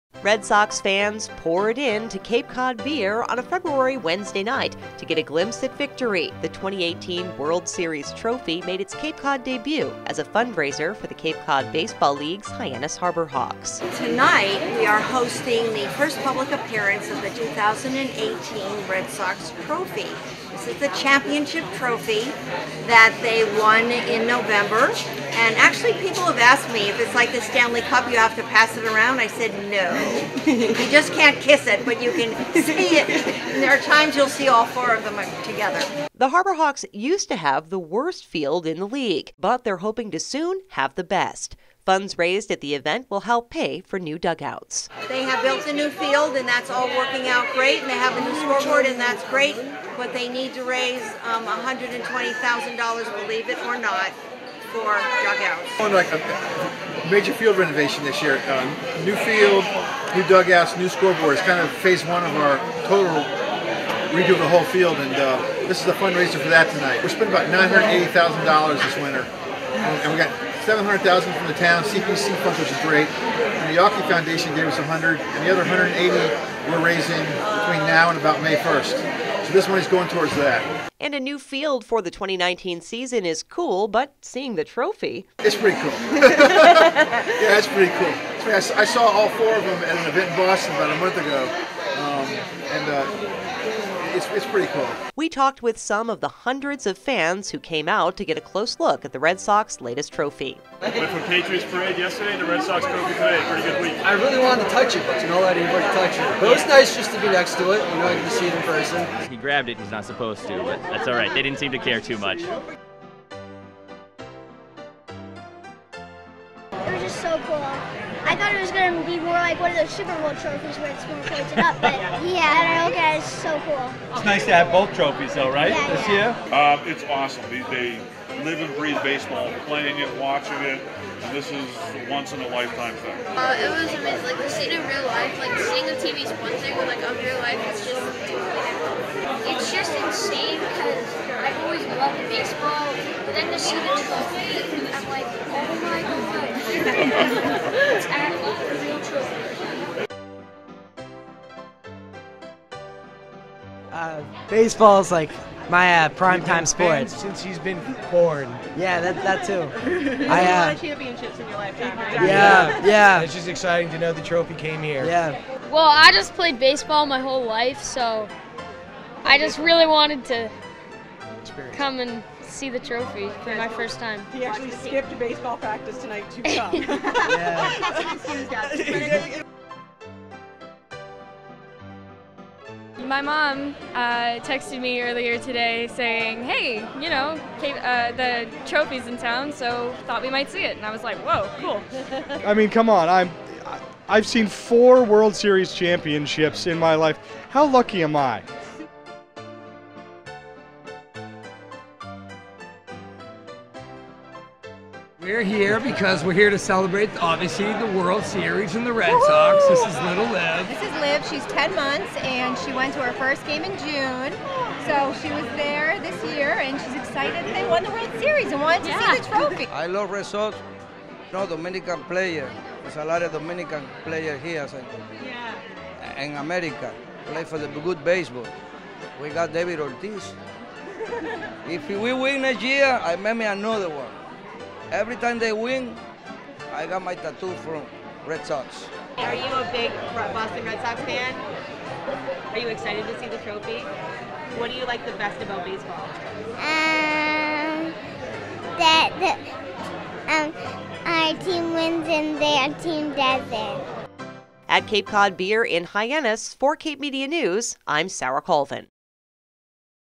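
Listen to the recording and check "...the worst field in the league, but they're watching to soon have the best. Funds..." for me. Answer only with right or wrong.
wrong.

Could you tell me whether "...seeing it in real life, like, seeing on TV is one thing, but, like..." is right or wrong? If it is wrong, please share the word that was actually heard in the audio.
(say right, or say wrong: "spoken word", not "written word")
right.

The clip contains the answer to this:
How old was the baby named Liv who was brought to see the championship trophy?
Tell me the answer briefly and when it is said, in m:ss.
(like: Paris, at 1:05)
10 months, at 3:31.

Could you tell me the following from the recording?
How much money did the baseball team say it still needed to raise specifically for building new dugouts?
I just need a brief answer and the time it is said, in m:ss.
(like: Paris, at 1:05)
$120,000, at 0:51.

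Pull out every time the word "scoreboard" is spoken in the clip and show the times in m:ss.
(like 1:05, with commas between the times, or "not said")
0:48, 1:00.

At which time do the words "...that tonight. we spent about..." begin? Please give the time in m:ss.
1:06.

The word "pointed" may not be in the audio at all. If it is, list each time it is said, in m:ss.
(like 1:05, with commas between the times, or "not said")
2:01.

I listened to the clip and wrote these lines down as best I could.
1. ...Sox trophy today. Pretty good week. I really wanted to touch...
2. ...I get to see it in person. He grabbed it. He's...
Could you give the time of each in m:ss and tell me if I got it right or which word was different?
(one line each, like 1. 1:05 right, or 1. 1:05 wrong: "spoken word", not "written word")
1. 1:42 right
2. 1:48 right.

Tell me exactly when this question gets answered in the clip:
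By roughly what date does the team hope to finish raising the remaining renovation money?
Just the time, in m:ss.
1:18.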